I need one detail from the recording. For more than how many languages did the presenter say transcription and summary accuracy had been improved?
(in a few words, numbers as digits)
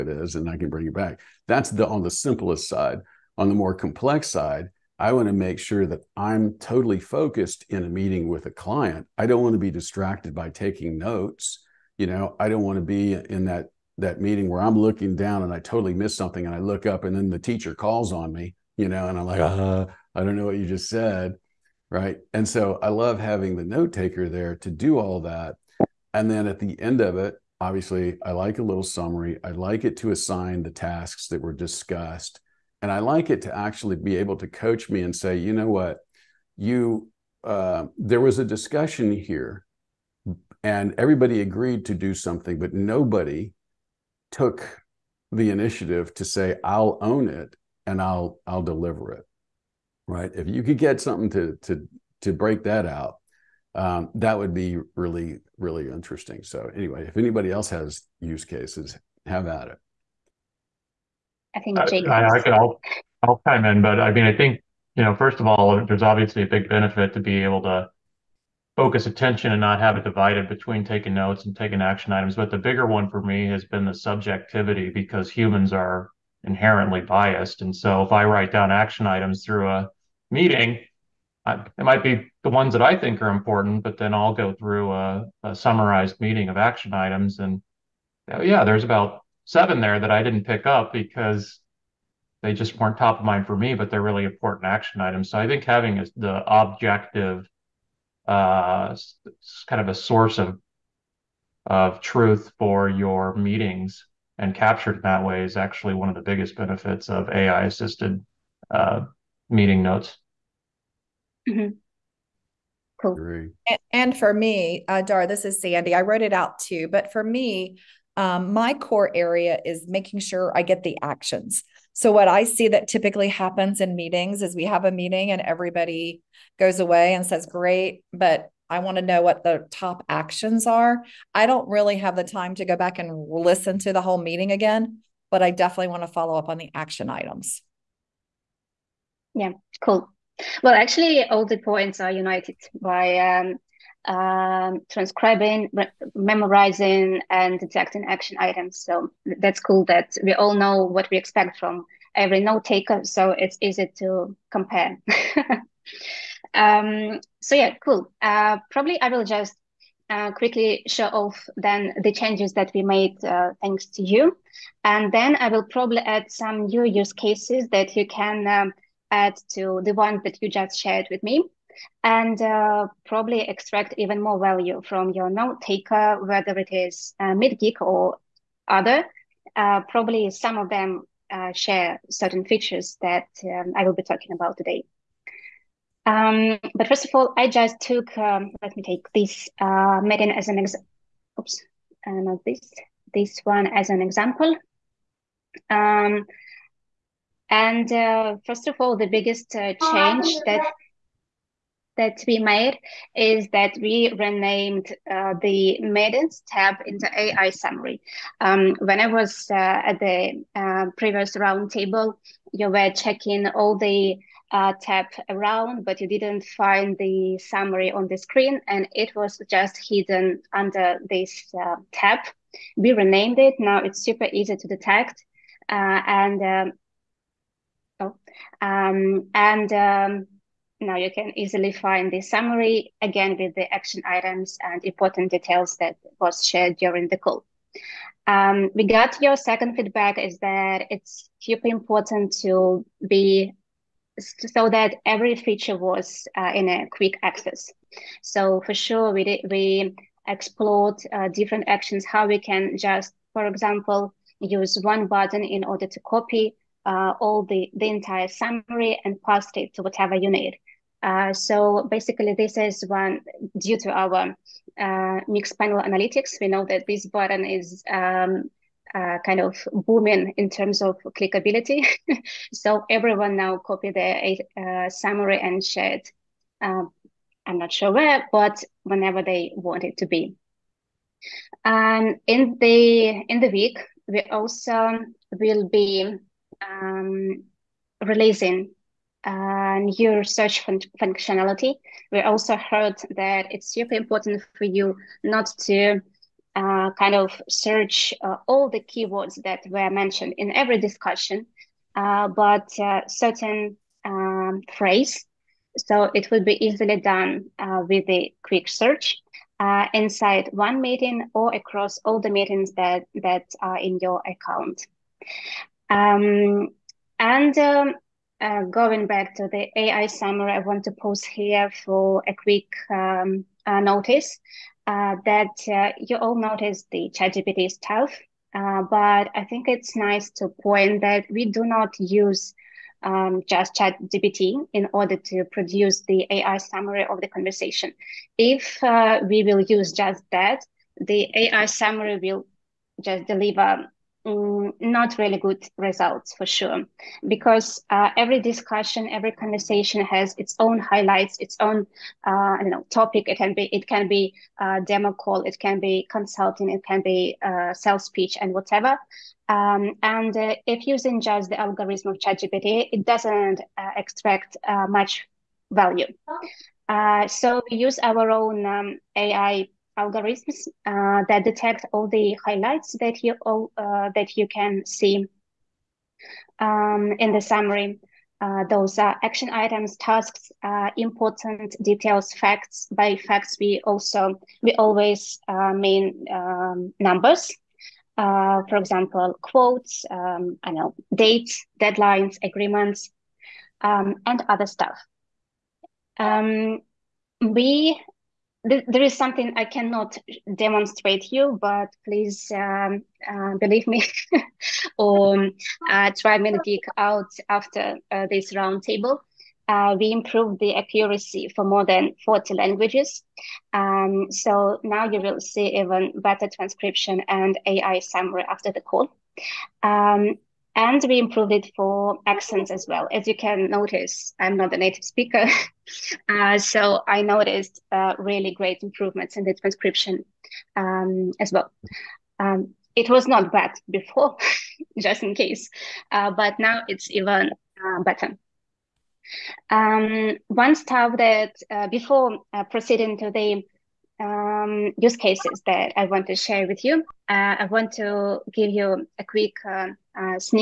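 40.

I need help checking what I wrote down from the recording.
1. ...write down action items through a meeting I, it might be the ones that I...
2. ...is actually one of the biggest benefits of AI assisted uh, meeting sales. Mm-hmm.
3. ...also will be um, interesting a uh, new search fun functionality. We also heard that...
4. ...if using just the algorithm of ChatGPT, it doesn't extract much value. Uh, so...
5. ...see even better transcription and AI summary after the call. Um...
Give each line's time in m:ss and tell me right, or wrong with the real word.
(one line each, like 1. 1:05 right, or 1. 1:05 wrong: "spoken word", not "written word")
1. 1:18 right
2. 1:45 wrong: "notes", not "sales"
3. 4:44 wrong: "releasing", not "interesting"
4. 6:00 right
5. 6:55 right.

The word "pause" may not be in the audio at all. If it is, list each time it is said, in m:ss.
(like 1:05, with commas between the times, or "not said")
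5:20.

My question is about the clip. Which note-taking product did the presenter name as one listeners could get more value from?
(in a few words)
MeetGeek.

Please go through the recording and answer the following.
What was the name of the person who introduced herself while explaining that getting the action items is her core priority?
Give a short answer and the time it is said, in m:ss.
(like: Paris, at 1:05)
Sandy, at 1:55.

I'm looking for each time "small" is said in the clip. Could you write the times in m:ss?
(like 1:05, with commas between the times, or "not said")
not said.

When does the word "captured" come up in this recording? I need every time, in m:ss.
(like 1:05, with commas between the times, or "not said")
1:44.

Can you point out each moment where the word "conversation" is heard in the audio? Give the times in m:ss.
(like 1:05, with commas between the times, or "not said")
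5:37, 5:49.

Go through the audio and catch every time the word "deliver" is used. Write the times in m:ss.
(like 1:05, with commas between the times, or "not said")
0:48, 5:43.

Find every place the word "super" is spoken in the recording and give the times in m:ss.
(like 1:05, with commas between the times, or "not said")
3:44, 4:01, 4:53.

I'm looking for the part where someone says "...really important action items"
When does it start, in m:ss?
1:34.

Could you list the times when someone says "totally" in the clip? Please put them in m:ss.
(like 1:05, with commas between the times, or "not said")
0:06, 0:15.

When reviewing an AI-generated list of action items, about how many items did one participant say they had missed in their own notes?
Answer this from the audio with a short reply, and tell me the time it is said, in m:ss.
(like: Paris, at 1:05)
7, at 1:29.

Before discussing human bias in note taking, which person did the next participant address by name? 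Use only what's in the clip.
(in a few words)
Jake.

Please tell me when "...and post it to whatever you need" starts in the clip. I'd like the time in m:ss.
4:19.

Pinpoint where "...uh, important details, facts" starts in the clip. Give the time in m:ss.
6:20.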